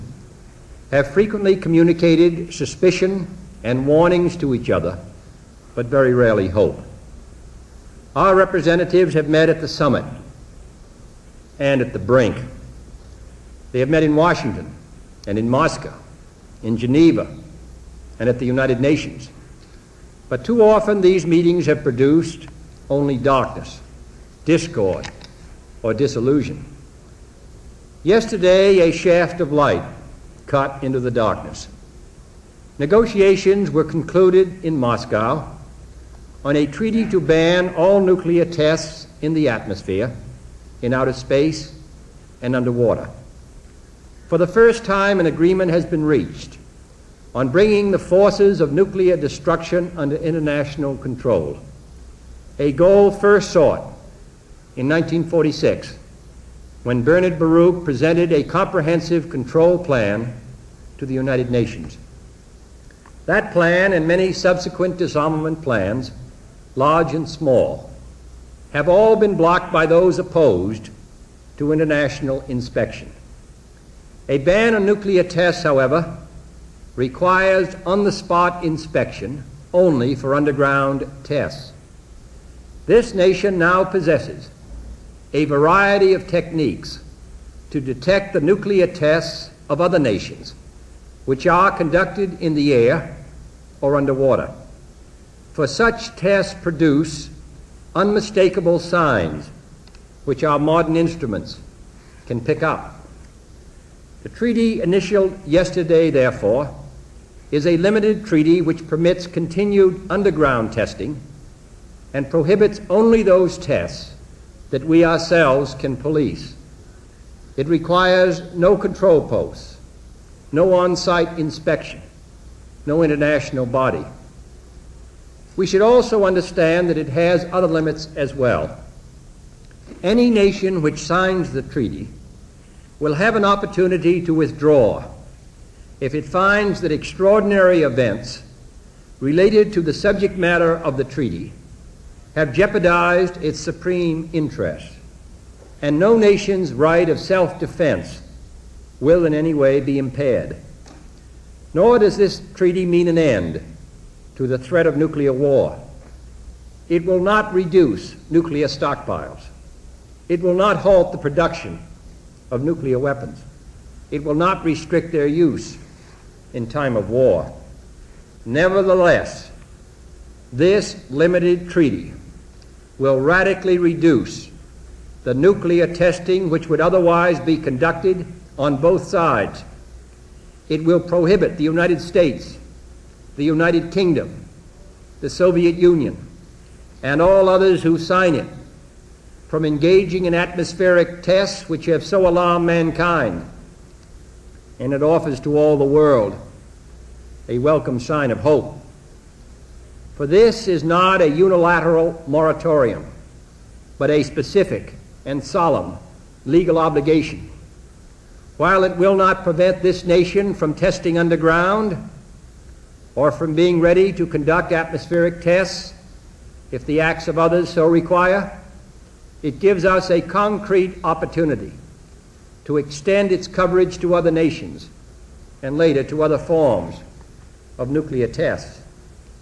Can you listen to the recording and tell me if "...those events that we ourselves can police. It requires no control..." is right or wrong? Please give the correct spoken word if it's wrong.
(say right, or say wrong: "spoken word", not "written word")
wrong: "tests", not "events".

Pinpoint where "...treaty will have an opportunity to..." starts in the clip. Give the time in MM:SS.
02:11.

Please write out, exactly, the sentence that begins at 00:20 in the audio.
But too often these meetings have produced only darkness, discord, or disillusion.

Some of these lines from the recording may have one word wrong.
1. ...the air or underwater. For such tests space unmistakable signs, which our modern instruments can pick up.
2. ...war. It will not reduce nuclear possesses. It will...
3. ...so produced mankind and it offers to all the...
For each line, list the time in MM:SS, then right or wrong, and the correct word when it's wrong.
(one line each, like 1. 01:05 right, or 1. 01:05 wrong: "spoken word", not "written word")
1. 01:32 wrong: "produce", not "space"
2. 02:35 wrong: "stockpiles", not "possesses"
3. 03:12 wrong: "alarmed", not "produced".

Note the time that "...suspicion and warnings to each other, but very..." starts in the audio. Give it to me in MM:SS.
00:02.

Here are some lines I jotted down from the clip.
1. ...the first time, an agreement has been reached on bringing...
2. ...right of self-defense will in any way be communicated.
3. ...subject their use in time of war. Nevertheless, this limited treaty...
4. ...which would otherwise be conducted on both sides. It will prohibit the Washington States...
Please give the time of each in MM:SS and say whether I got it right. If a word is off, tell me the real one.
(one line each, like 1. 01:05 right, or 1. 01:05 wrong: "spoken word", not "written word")
1. 00:44 right
2. 02:26 wrong: "impaired", not "communicated"
3. 02:44 wrong: "restrict", not "subject"
4. 02:56 wrong: "United", not "Washington".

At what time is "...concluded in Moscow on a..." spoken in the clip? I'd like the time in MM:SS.
00:33.